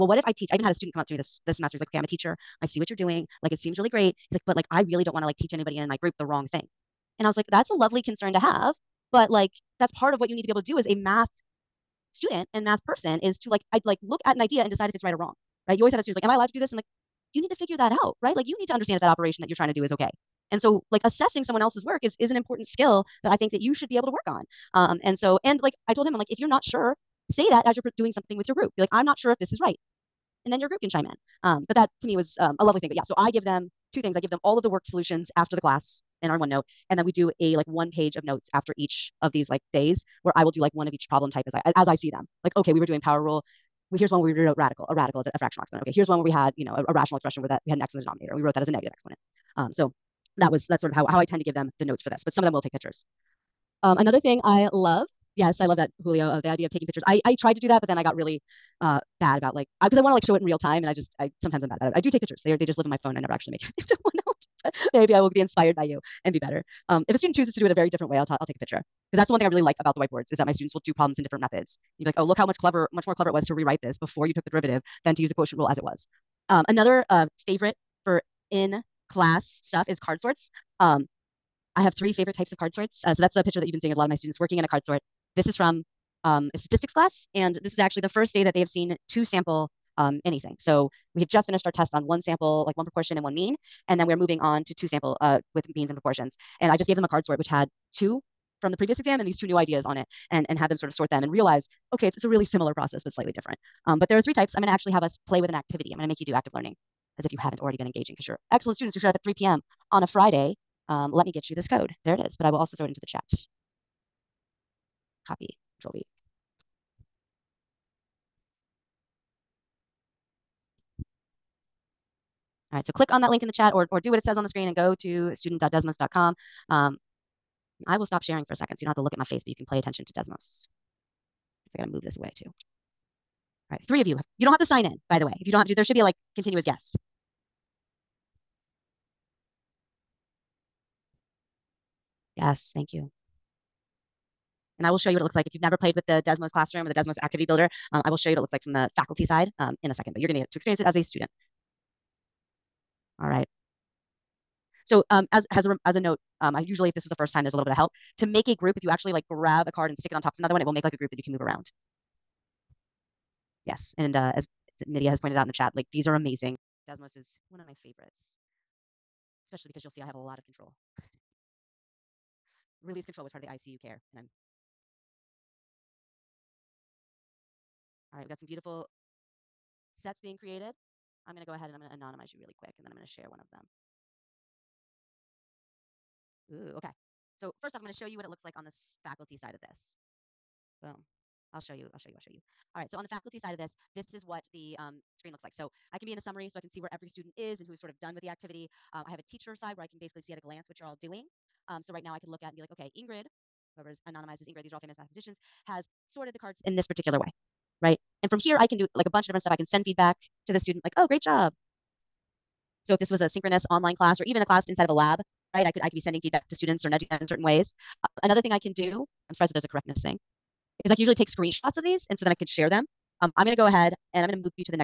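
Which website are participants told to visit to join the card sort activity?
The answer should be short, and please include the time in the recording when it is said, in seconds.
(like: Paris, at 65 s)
student.desmos.com, at 125 s.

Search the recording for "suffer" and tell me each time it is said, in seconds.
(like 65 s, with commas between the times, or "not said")
not said.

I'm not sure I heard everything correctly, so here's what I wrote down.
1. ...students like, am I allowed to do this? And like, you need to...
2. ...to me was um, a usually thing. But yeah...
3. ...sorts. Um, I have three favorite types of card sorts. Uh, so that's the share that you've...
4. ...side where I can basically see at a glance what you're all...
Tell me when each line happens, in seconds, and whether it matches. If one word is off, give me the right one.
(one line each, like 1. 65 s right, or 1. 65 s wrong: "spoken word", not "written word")
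1. 16 s right
2. 32 s wrong: "lovely", not "usually"
3. 80 s wrong: "picture", not "share"
4. 199 s right.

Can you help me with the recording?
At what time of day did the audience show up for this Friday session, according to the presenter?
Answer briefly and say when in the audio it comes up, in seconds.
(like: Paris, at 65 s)
3 p.m., at 109 s.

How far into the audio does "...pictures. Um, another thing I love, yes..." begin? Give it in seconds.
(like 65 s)
52 s.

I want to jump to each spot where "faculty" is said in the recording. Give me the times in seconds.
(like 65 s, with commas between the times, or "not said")
148 s, 189 s, 193 s.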